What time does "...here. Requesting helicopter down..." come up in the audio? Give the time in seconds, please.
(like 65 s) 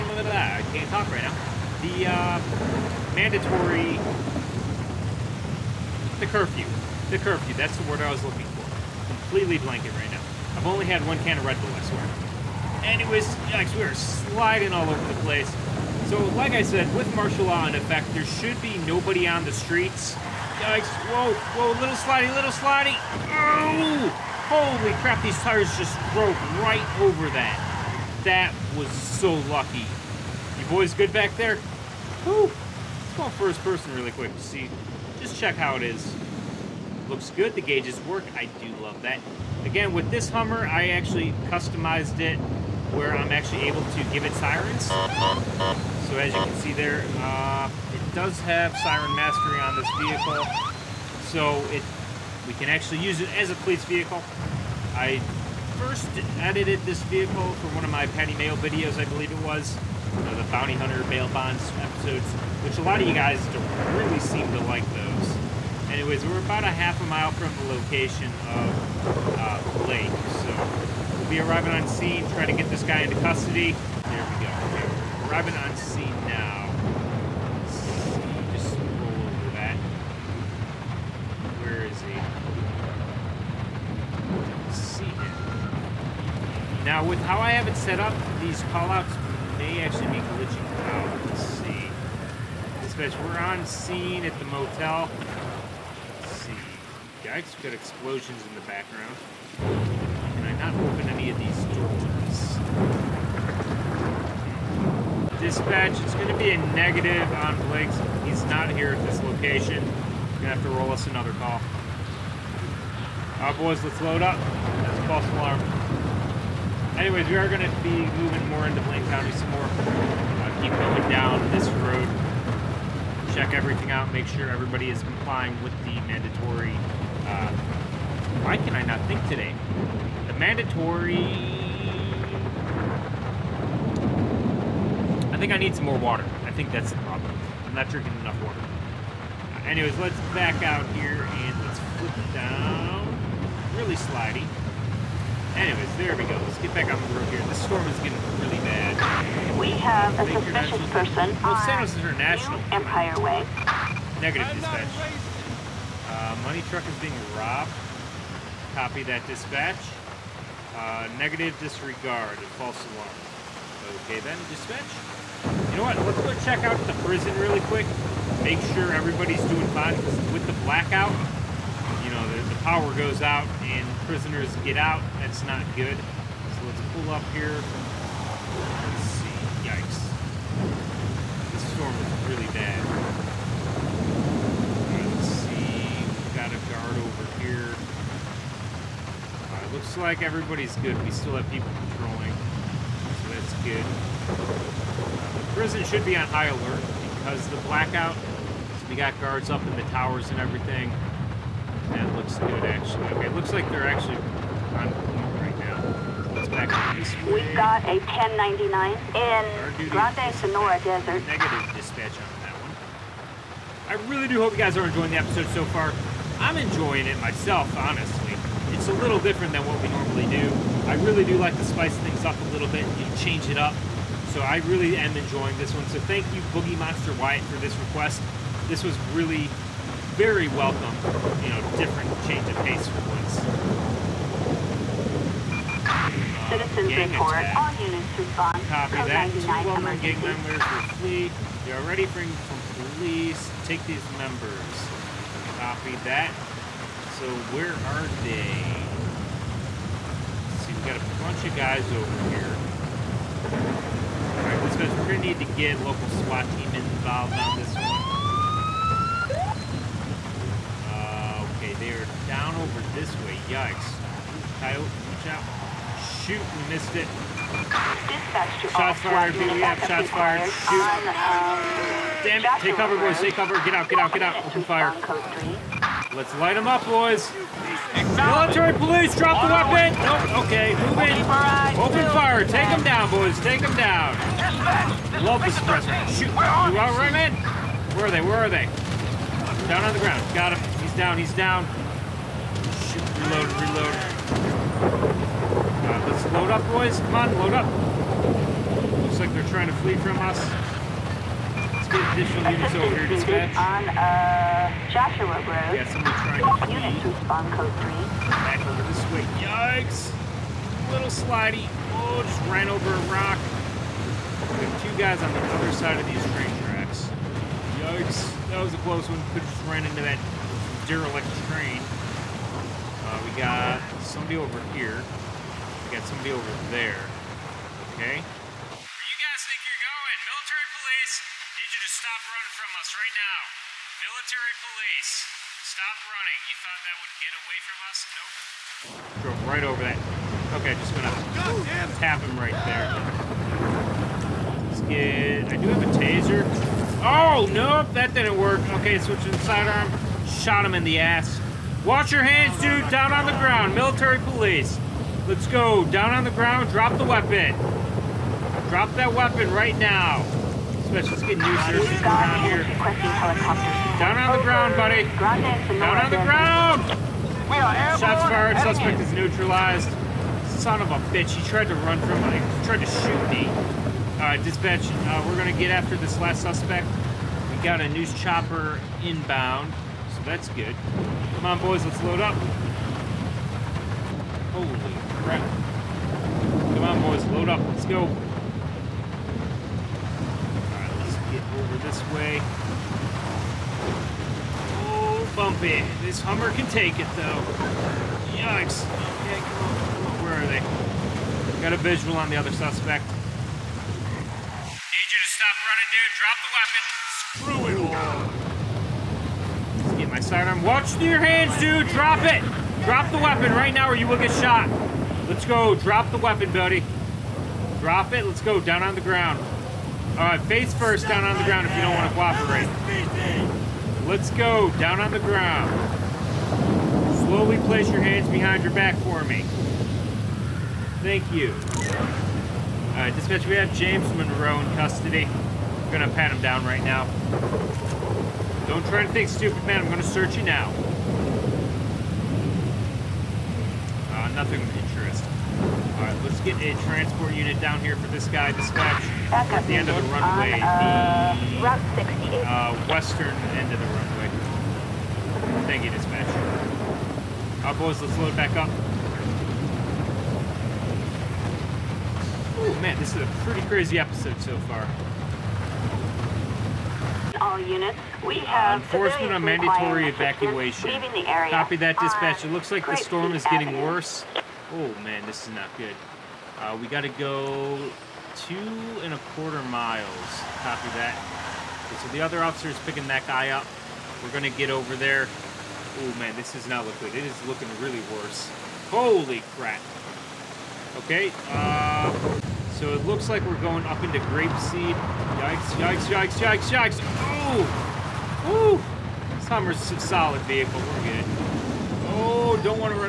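362 s.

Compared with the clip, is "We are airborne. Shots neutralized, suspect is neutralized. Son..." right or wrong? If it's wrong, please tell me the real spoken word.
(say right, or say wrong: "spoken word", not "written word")
wrong: "fired", not "neutralized".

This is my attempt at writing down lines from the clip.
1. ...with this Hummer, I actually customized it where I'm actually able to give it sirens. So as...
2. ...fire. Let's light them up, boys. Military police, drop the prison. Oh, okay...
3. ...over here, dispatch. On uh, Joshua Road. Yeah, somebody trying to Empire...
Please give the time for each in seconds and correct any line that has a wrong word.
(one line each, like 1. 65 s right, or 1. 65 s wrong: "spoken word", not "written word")
1. 39 s right
2. 274 s wrong: "weapon", not "prison"
3. 302 s wrong: "Units", not "Empire".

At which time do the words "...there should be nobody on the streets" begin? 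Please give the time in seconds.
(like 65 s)
18 s.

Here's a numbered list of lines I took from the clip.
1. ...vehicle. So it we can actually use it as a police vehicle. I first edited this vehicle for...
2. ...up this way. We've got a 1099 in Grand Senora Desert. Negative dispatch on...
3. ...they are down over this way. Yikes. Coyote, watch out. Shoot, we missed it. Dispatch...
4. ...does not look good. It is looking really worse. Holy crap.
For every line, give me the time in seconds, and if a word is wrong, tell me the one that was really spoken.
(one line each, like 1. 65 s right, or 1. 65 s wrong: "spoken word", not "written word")
1. 49 s right
2. 206 s right
3. 261 s right
4. 486 s right.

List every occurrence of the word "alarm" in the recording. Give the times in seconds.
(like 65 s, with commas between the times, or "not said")
115 s, 162 s.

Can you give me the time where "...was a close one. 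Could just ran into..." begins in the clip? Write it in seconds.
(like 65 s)
318 s.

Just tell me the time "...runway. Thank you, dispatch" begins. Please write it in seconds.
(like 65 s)
453 s.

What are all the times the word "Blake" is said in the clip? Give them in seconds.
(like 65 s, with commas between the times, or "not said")
69 s, 107 s.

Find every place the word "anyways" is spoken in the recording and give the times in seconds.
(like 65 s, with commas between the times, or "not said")
12 s, 65 s, 116 s, 139 s, 145 s.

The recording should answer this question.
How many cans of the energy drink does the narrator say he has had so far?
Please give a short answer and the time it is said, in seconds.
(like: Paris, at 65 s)
1, at 11 s.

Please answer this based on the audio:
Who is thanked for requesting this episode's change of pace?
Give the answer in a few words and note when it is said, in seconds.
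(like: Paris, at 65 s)
Boogie Monster Wyatt, at 226 s.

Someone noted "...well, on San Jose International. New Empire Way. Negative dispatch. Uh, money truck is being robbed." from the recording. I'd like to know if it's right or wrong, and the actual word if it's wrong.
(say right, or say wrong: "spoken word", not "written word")
right.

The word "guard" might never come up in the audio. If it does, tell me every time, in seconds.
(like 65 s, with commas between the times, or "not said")
186 s, 199 s.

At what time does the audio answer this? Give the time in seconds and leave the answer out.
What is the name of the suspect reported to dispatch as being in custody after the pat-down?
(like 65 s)
433 s.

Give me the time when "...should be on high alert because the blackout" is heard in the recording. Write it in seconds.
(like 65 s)
195 s.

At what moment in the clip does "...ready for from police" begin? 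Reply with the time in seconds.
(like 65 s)
241 s.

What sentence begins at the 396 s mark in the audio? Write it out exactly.
This Hummer can take it though.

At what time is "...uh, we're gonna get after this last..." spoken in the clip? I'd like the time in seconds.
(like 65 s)
375 s.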